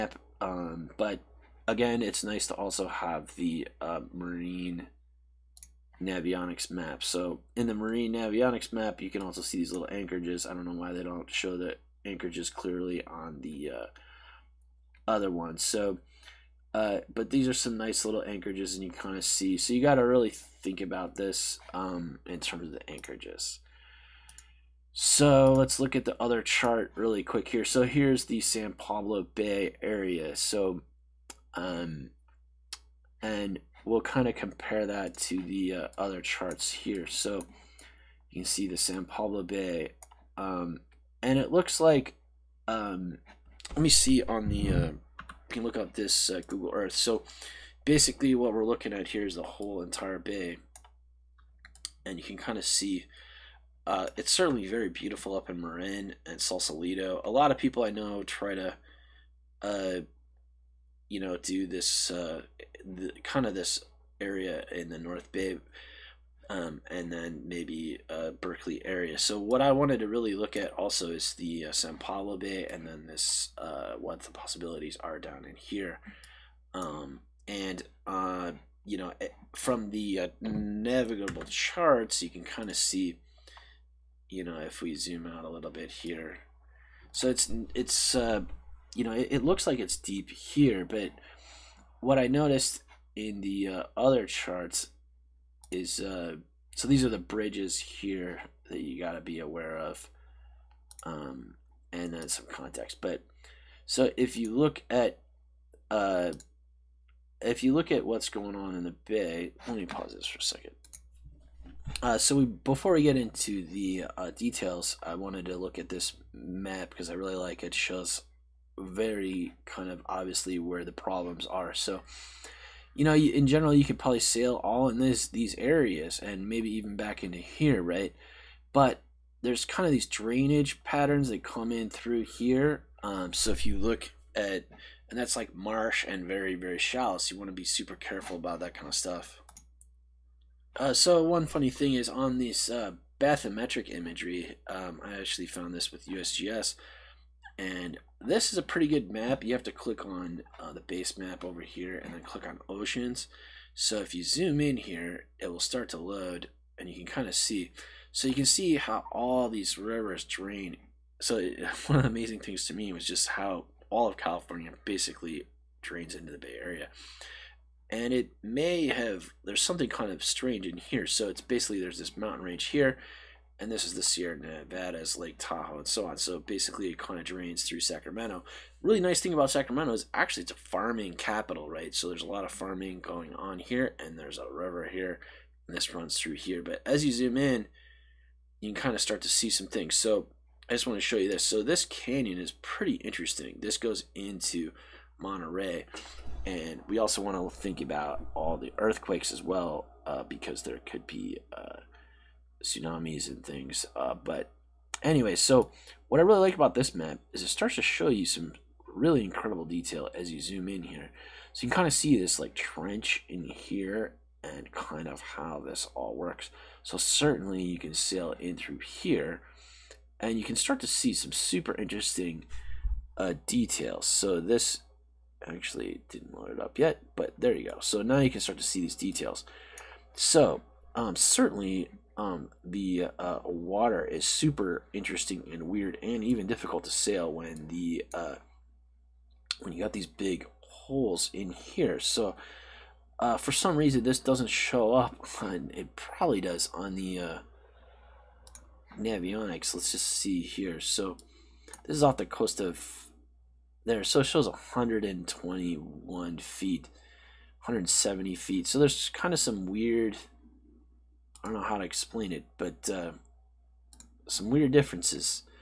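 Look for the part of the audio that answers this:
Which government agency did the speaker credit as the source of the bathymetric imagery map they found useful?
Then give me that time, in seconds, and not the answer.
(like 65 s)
146 s.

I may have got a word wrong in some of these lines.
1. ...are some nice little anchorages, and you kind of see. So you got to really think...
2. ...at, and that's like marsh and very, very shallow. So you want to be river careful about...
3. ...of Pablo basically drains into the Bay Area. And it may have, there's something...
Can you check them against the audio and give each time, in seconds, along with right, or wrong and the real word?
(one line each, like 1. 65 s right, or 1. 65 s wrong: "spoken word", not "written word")
1. 17 s right
2. 134 s wrong: "super", not "river"
3. 164 s wrong: "California", not "Pablo".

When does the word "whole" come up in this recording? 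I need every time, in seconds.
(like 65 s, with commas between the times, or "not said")
49 s.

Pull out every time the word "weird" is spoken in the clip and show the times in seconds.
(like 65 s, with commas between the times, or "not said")
235 s, 259 s, 264 s.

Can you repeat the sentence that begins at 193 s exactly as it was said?
This goes into Monterey, and we also want to think about all the earthquakes as well, uh, because there could be.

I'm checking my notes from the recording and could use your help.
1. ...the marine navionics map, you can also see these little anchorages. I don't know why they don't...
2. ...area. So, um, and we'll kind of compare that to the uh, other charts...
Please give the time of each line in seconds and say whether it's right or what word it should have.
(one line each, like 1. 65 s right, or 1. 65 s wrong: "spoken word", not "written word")
1. 7 s right
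2. 29 s right.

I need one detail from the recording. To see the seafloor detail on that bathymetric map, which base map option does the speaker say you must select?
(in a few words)
oceans.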